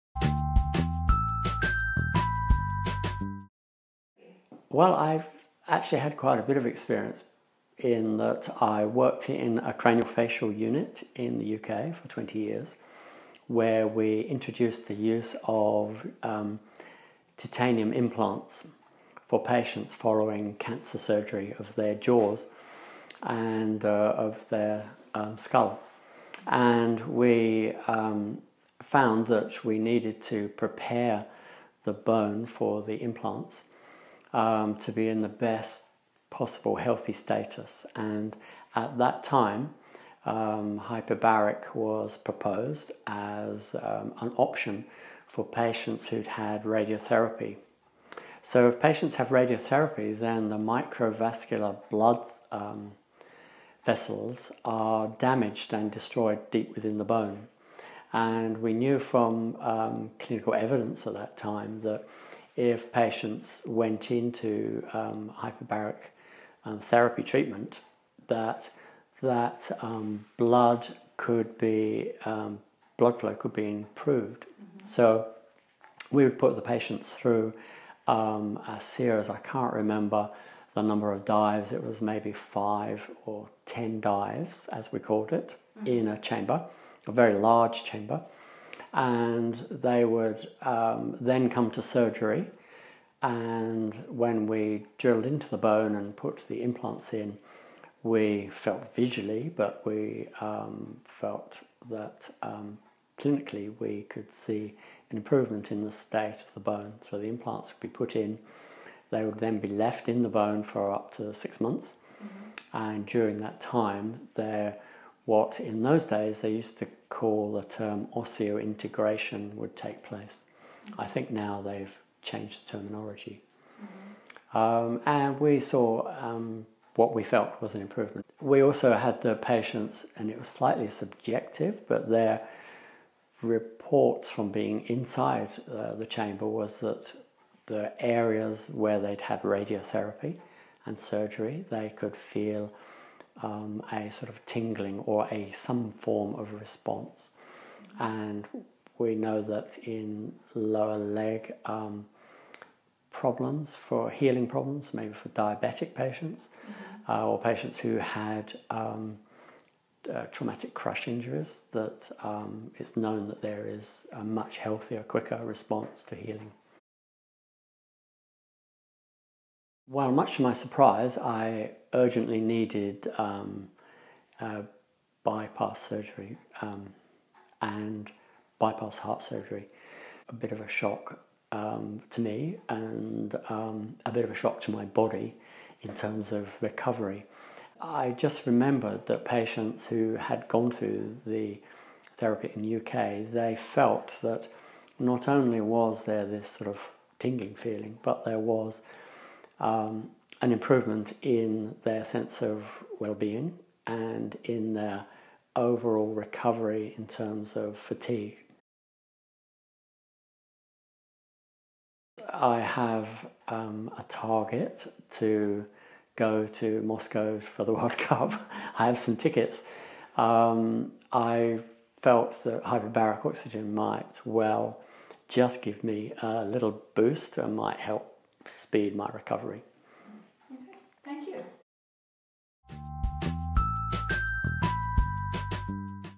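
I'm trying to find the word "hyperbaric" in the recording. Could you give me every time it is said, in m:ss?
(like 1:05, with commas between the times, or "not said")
0:40, 1:05, 3:42.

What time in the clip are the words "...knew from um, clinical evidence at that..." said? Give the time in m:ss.
0:58.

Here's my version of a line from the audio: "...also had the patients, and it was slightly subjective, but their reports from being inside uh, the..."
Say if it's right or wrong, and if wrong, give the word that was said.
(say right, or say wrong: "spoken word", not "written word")
right.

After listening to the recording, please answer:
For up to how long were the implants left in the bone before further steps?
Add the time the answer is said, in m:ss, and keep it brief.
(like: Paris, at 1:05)
six months, at 1:51.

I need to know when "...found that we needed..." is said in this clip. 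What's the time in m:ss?
0:28.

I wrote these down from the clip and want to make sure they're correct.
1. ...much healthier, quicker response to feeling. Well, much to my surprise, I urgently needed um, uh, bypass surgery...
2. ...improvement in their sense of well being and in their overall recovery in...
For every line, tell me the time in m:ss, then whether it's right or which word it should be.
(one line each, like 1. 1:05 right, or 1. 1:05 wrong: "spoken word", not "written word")
1. 2:44 wrong: "healing", not "feeling"
2. 3:20 right.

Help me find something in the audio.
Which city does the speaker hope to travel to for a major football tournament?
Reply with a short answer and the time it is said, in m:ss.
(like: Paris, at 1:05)
Moscow, at 3:36.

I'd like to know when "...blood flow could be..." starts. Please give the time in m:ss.
1:12.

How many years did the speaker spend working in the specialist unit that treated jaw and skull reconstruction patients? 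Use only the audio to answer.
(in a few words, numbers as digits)
20 years.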